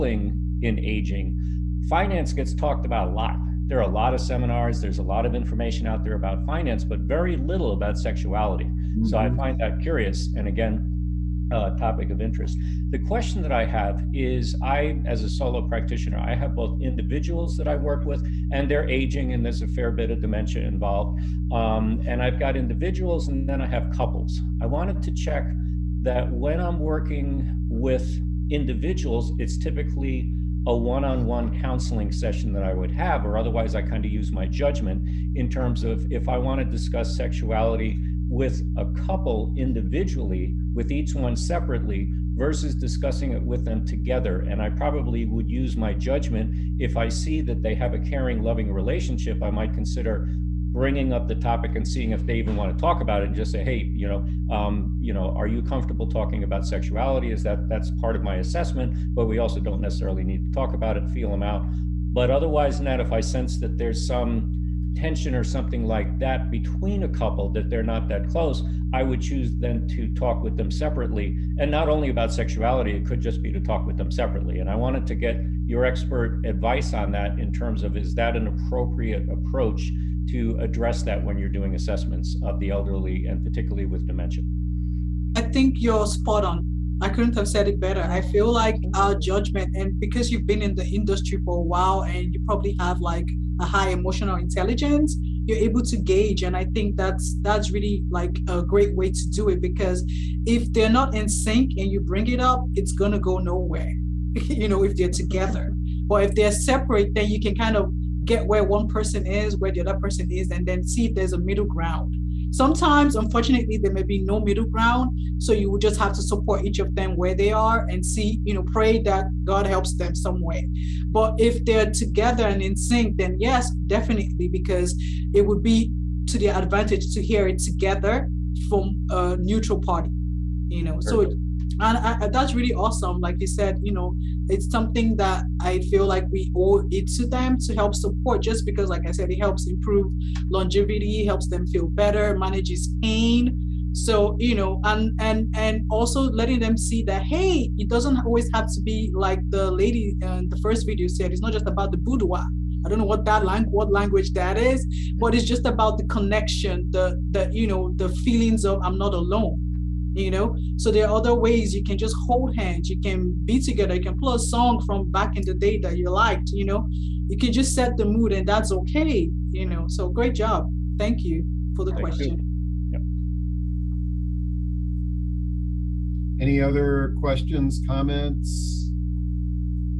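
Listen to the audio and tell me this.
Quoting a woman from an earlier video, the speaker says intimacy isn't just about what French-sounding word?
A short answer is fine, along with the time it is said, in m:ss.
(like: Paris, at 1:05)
boudoir, at 2:31.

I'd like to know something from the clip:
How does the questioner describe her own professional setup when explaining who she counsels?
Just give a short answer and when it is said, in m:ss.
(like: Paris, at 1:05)
solo practitioner, at 0:15.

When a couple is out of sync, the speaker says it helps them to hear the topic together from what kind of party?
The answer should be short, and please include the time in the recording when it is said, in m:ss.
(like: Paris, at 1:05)
neutral party, at 2:09.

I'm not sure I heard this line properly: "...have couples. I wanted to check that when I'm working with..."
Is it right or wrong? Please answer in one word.
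right.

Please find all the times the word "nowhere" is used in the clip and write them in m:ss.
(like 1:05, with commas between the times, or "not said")
1:43.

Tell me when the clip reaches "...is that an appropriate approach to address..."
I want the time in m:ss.
1:17.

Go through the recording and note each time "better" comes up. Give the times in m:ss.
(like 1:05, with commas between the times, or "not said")
1:27, 2:21.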